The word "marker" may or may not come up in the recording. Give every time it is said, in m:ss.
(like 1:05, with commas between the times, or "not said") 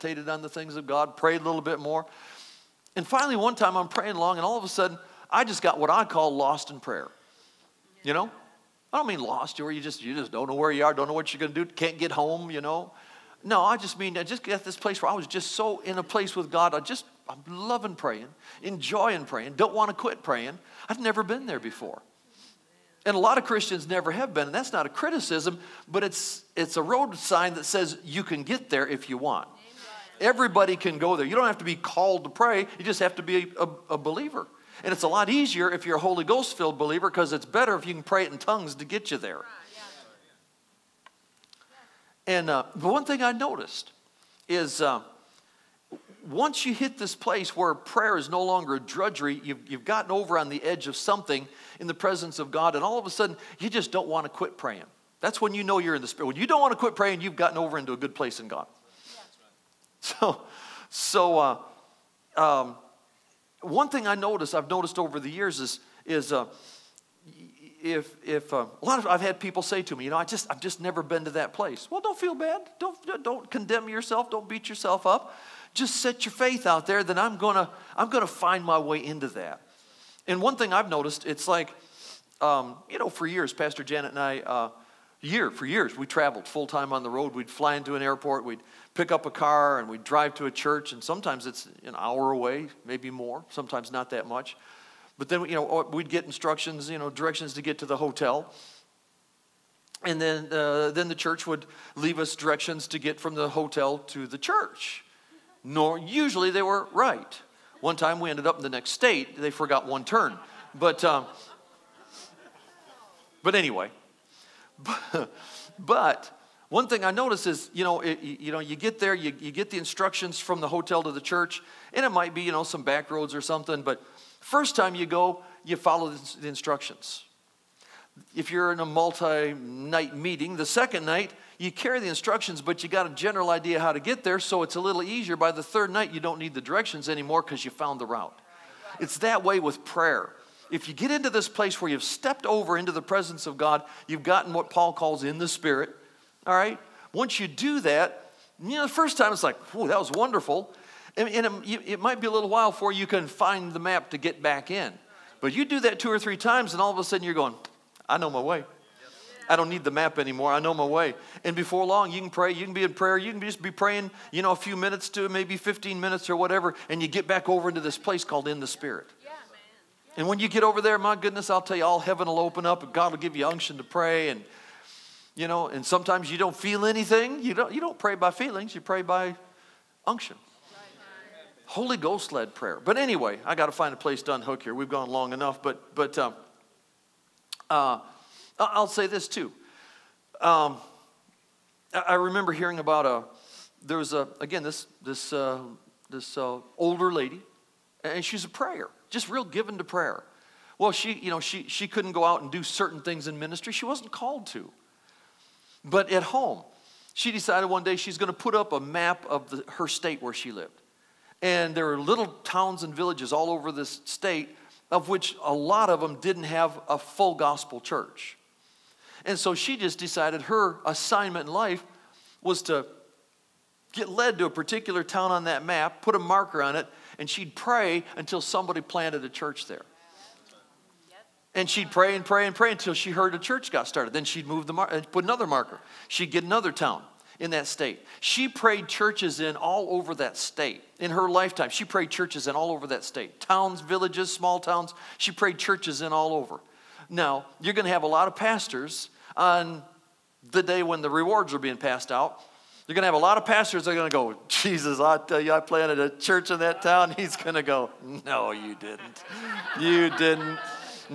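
3:46, 3:55.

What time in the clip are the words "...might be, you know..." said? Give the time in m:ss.
2:02.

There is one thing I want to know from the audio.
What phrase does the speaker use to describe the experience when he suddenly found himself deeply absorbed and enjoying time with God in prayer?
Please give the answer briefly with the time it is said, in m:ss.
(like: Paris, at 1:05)
lost in prayer, at 0:06.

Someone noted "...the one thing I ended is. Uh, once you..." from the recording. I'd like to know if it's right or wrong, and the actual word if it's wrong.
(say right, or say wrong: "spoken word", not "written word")
wrong: "noticed", not "ended".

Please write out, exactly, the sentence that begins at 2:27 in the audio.
Once you do that, you know, the first time it's like, whoa, that was wonderful.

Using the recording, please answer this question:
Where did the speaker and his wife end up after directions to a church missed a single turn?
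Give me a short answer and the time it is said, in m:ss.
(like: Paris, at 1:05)
the next state, at 1:48.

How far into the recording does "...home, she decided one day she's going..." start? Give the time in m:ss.
3:26.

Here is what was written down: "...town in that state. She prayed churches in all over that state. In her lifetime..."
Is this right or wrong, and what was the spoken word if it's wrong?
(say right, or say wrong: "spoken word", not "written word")
right.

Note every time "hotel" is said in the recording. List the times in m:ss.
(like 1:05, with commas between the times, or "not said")
1:37, 1:43, 2:00.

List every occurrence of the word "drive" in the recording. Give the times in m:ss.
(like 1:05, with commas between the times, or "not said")
1:30.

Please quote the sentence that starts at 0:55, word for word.
That's when you know you're in the Spirit.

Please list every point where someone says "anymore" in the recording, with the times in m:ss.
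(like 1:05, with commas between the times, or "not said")
2:17, 2:40.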